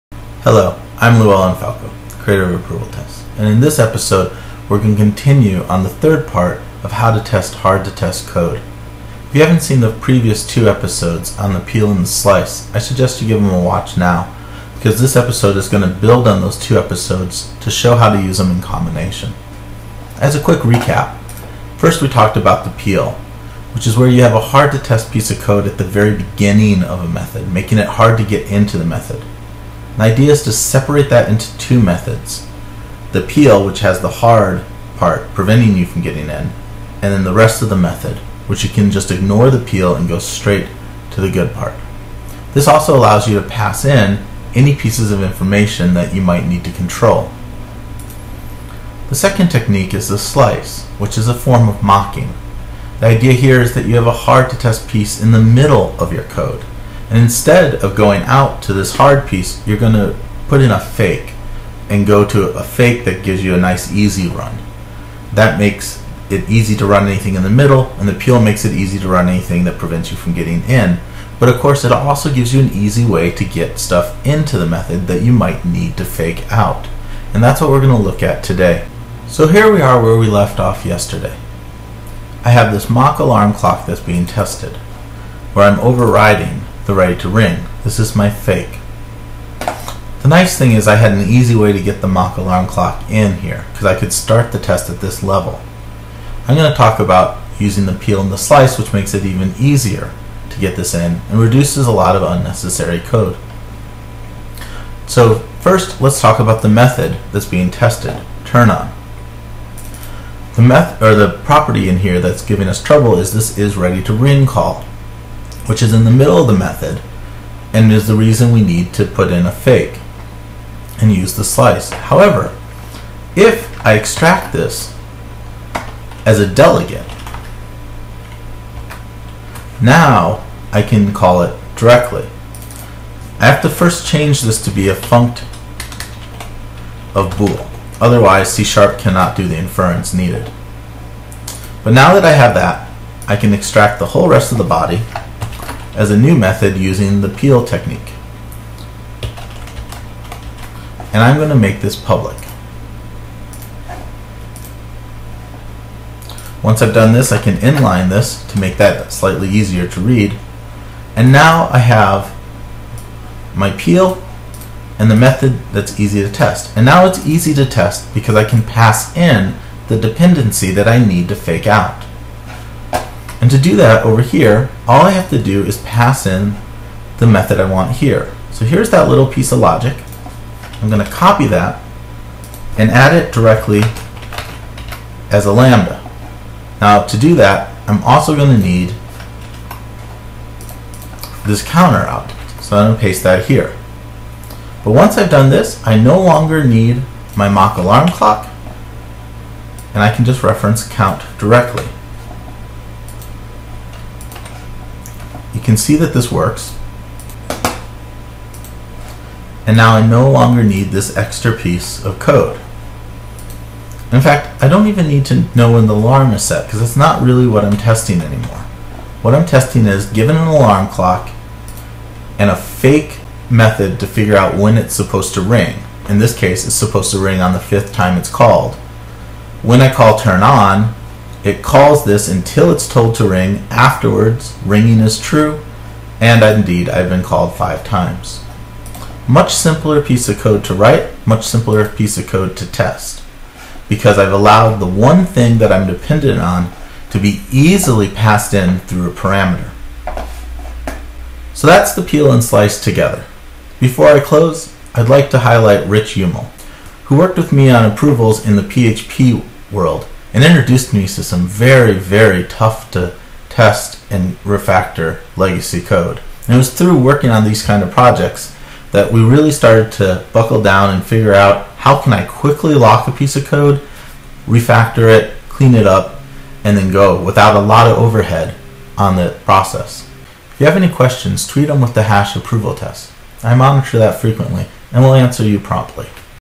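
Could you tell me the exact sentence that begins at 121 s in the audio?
However, if I extract this as a delegate, now I can call it directly.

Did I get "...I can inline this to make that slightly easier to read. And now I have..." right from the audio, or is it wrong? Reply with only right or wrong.
right.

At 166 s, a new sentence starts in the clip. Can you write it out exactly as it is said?
And now it's easy to test because I can pass in the dependency that I need to fake out.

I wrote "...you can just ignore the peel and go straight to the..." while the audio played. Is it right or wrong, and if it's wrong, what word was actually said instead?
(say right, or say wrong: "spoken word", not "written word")
right.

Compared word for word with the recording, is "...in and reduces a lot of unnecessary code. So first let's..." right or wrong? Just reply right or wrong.
right.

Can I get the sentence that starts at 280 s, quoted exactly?
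If you have any questions, tweet them with the hash approval test.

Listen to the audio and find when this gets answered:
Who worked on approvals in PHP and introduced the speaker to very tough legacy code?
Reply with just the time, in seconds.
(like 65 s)
255 s.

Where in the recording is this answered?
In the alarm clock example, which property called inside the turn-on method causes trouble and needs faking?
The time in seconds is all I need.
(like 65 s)
113 s.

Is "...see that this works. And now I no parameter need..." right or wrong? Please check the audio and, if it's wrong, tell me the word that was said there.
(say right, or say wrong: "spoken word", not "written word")
wrong: "longer", not "parameter".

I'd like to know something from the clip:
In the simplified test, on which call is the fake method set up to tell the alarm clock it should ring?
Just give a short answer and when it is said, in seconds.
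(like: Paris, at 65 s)
5th, at 227 s.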